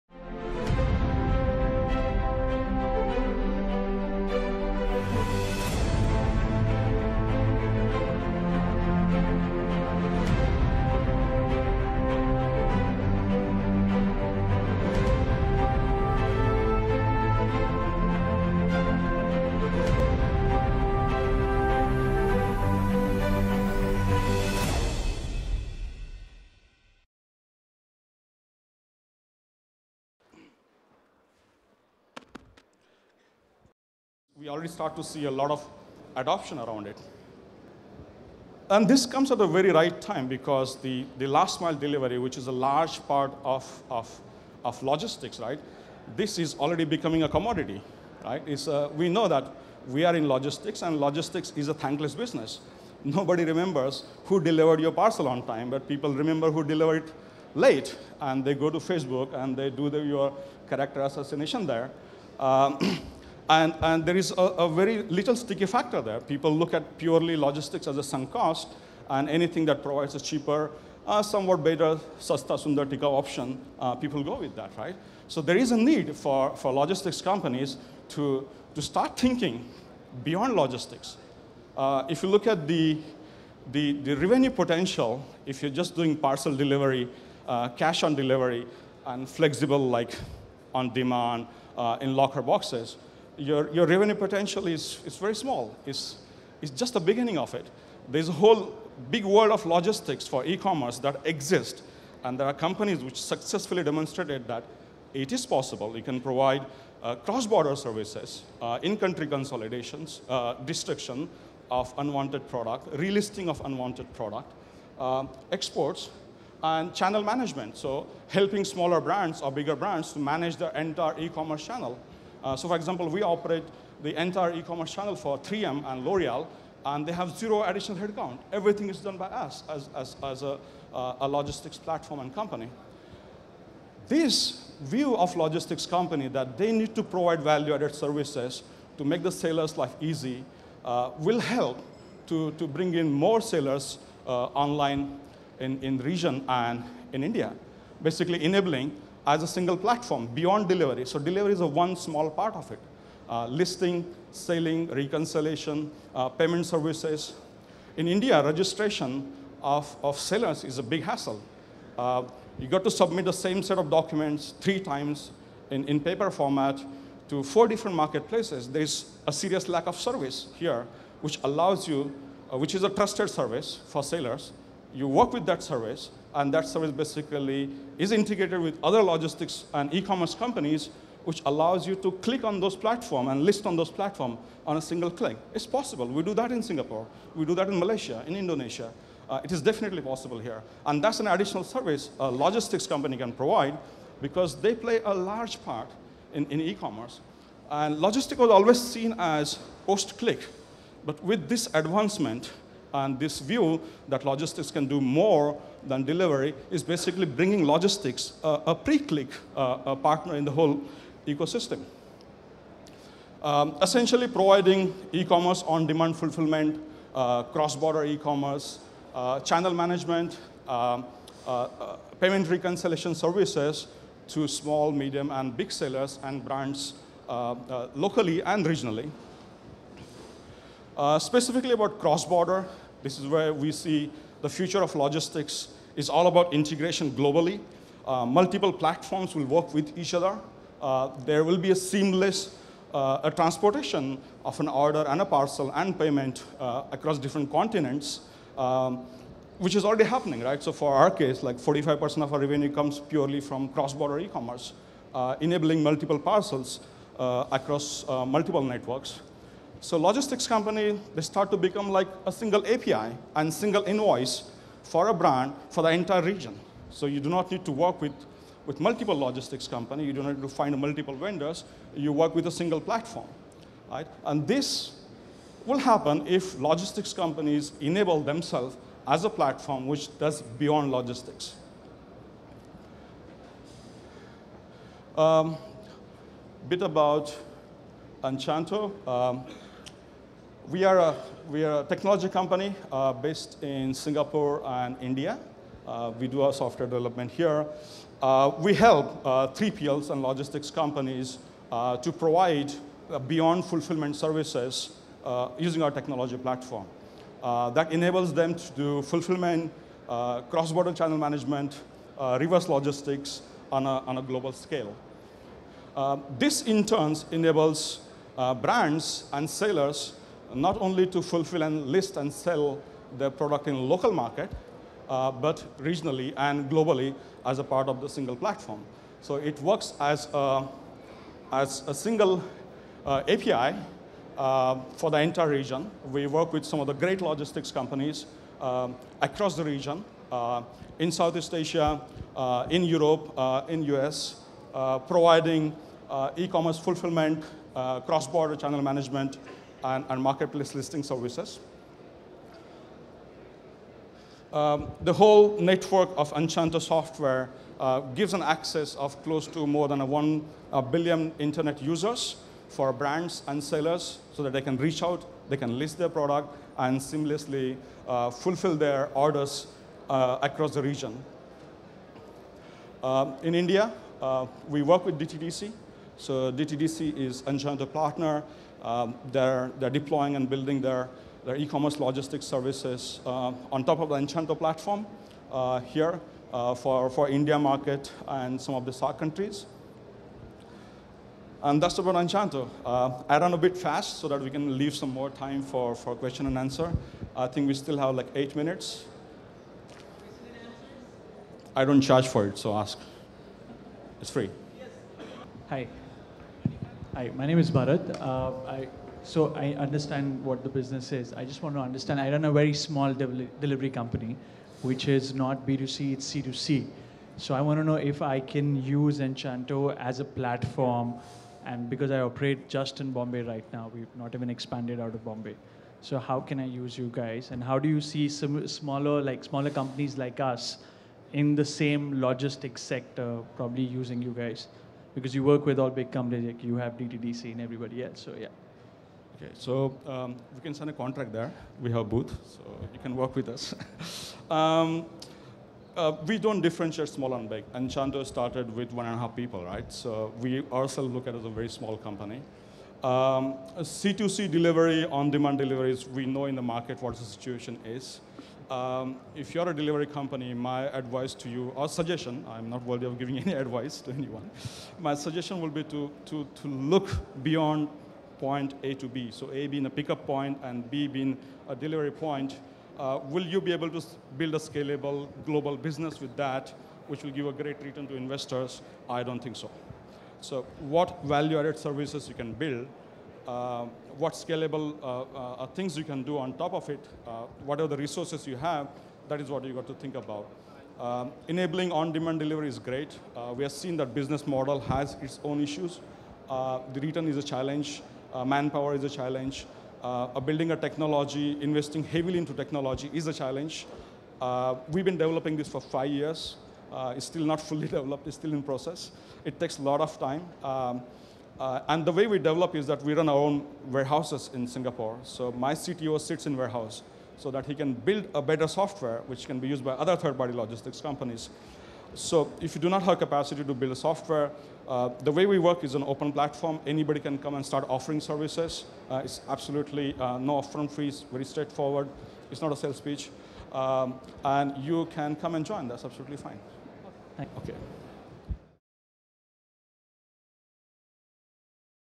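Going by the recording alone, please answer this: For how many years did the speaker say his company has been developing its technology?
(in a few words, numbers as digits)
5.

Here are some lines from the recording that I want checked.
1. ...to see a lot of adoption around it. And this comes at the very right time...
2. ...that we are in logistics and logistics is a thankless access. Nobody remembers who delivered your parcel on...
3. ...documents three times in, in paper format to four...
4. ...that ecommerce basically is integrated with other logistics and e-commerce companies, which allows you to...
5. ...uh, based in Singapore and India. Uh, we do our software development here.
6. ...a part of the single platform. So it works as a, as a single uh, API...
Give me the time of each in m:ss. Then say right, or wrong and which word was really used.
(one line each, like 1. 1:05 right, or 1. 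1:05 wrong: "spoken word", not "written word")
1. 0:34 right
2. 0:49 wrong: "business", not "access"
3. 2:43 right
4. 2:56 wrong: "service", not "ecommerce"
5. 4:52 right
6. 5:27 right.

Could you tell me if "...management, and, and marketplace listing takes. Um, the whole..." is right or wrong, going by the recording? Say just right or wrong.
wrong.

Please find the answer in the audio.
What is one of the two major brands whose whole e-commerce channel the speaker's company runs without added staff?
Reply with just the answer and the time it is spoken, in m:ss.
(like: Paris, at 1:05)
3M, at 2:05.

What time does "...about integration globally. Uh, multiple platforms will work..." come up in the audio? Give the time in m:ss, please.
3:56.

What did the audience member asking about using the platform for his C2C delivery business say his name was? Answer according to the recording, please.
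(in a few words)
Bharat.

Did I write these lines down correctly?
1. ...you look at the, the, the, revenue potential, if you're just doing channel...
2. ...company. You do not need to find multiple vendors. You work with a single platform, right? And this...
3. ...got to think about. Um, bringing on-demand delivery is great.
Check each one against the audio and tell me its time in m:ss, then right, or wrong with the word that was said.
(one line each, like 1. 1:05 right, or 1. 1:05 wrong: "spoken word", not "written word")
1. 1:22 wrong: "parcel", not "channel"
2. 4:29 right
3. 8:09 wrong: "enabling", not "bringing".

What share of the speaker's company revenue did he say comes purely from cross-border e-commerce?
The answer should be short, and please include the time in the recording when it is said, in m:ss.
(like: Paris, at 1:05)
45%, at 4:11.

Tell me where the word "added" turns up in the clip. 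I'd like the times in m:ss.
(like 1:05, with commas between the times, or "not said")
2:17, 8:01.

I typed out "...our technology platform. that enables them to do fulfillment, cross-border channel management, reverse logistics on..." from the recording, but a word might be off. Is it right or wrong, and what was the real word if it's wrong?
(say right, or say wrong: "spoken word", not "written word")
right.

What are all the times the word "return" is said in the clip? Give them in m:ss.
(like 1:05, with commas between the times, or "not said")
7:57, 8:16.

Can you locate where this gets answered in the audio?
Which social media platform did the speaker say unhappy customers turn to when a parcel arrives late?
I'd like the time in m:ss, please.
0:58.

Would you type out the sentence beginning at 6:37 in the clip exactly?
I think we still have like eight minutes.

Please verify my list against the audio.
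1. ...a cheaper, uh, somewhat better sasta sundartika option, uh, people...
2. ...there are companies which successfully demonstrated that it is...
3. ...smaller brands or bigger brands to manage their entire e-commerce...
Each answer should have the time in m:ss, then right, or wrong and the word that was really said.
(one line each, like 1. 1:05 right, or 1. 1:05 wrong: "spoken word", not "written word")
1. 1:10 right
2. 1:42 right
3. 1:58 right.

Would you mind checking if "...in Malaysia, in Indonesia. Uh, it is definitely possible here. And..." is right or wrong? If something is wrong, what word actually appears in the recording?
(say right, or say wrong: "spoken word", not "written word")
right.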